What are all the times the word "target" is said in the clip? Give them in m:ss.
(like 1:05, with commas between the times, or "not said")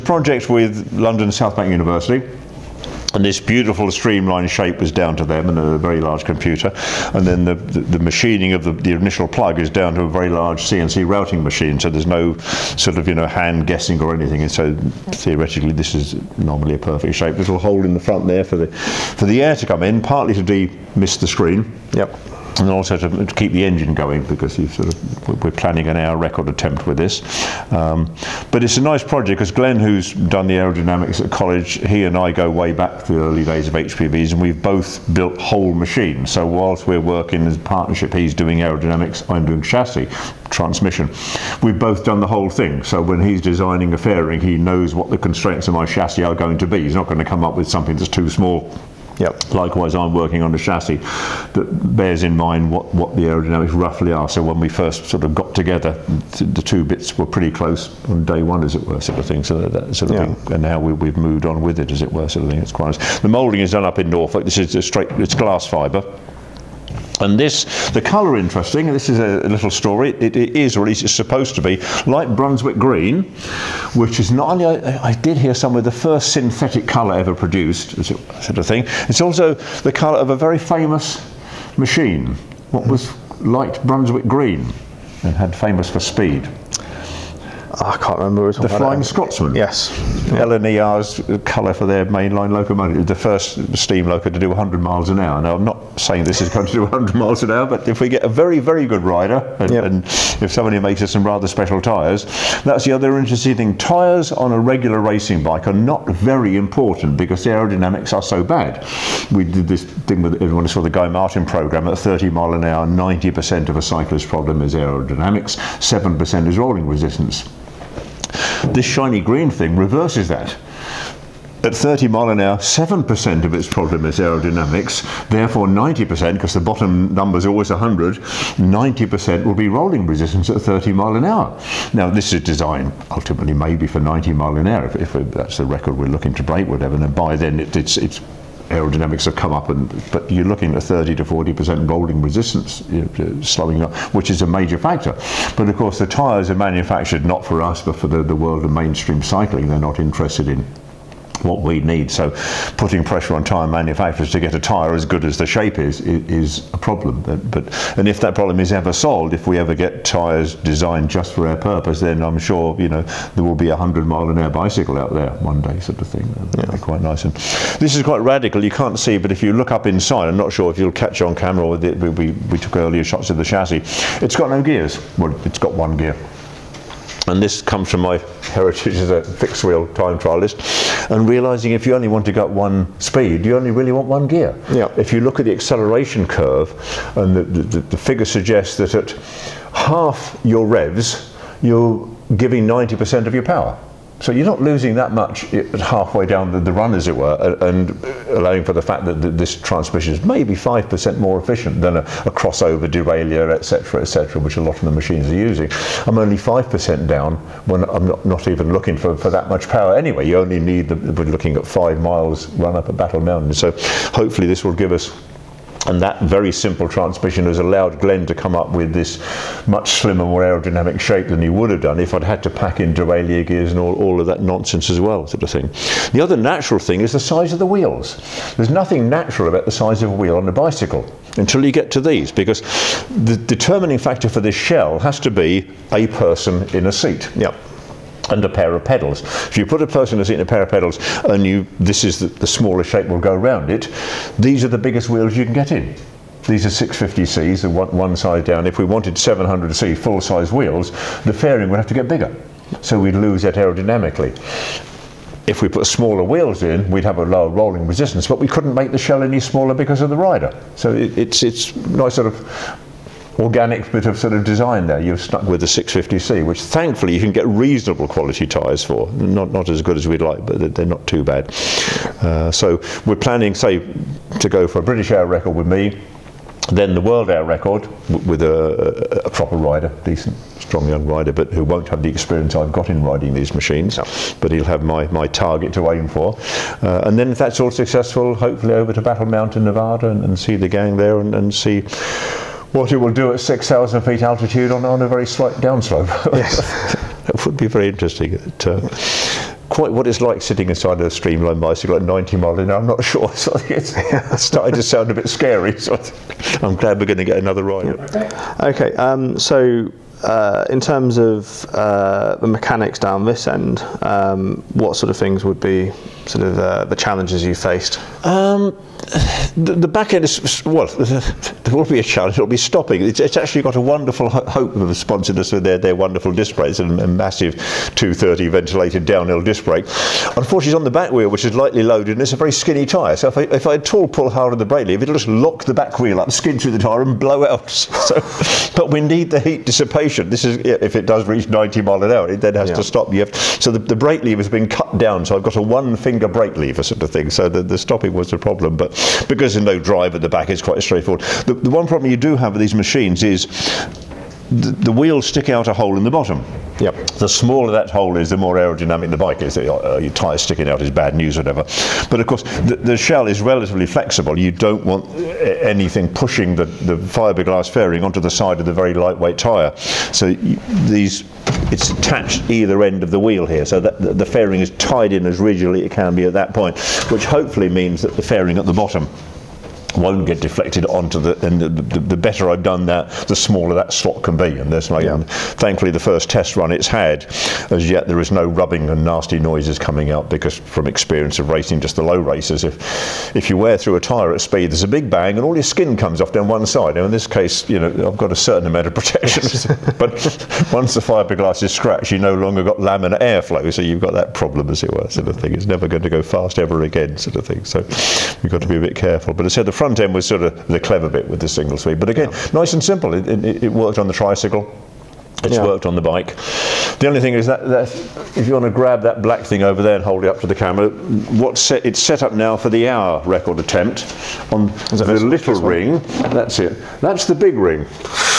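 4:45.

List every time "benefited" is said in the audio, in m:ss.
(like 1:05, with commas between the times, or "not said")
not said.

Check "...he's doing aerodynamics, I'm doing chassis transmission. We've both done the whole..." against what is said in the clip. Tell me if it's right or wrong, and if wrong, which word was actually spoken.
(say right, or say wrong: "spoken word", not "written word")
right.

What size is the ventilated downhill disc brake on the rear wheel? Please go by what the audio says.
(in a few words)
230.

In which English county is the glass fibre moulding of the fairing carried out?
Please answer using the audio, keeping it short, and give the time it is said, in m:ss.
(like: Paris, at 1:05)
Norfolk, at 1:04.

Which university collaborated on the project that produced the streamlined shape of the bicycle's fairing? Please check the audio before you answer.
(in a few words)
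London South Bank University.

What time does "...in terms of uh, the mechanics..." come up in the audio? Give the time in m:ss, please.
5:10.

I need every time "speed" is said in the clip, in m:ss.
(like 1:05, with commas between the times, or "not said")
1:26, 3:02, 6:34, 6:51.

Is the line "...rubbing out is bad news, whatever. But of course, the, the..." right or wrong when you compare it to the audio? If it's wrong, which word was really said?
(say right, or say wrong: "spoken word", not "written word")
wrong: "sticking", not "rubbing".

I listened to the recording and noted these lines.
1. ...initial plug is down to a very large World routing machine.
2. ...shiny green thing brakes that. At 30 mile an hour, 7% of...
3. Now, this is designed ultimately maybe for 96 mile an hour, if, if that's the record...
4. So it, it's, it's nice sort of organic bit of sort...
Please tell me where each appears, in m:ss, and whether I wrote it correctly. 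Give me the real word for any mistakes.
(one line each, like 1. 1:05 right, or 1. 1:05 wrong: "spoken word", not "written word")
1. 0:08 wrong: "CNC", not "World"
2. 1:58 wrong: "reverses", not "brakes"
3. 2:11 wrong: "90", not "96"
4. 4:20 right.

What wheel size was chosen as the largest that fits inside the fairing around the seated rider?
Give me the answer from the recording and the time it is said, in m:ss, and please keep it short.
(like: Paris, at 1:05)
650C, at 4:06.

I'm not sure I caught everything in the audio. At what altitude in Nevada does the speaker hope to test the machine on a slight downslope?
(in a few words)
6,000 feet.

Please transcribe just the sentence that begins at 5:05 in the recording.
So I'm glad we're going to get another ride.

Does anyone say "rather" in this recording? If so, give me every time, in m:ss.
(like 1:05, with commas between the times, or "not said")
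1:41.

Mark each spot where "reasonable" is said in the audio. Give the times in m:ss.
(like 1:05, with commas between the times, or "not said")
4:27.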